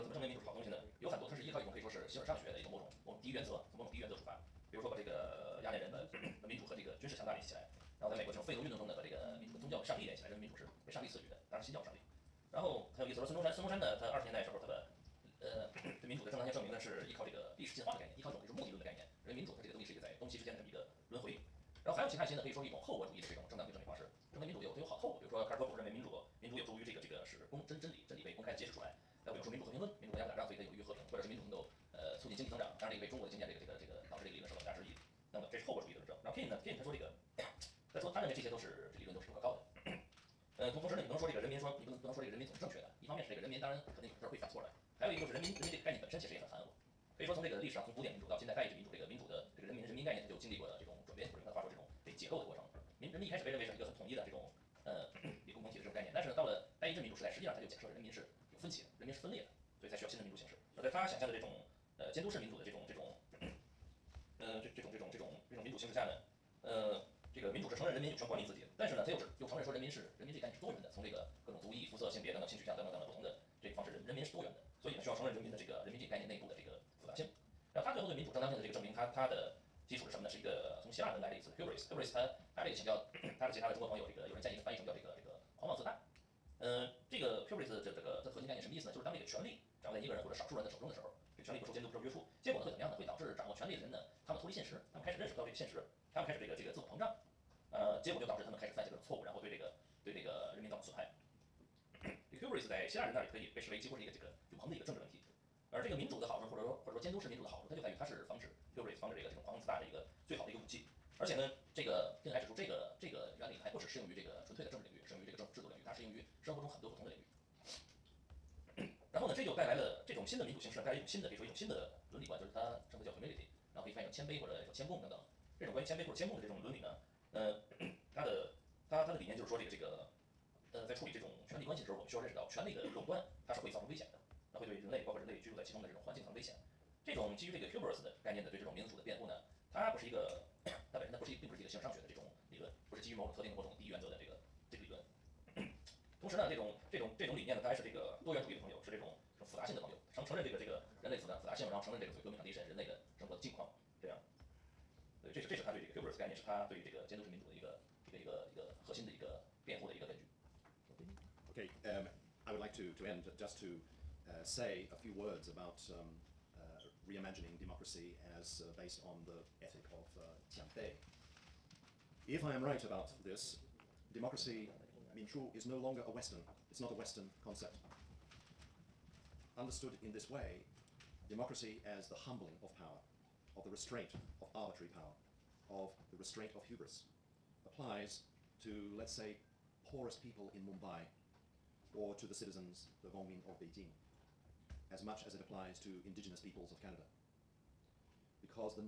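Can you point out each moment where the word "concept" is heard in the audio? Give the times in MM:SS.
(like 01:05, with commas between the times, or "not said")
02:57.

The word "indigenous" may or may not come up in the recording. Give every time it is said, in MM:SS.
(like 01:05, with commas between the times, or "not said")
03:16.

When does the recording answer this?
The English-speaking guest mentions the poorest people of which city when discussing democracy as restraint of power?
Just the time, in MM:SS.
03:10.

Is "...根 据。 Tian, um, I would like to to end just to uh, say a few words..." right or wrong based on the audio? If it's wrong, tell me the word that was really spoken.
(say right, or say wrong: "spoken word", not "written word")
wrong: "Okay", not "Tian".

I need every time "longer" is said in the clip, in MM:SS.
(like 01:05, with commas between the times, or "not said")
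02:55.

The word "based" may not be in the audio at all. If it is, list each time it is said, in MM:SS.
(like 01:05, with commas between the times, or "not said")
02:48.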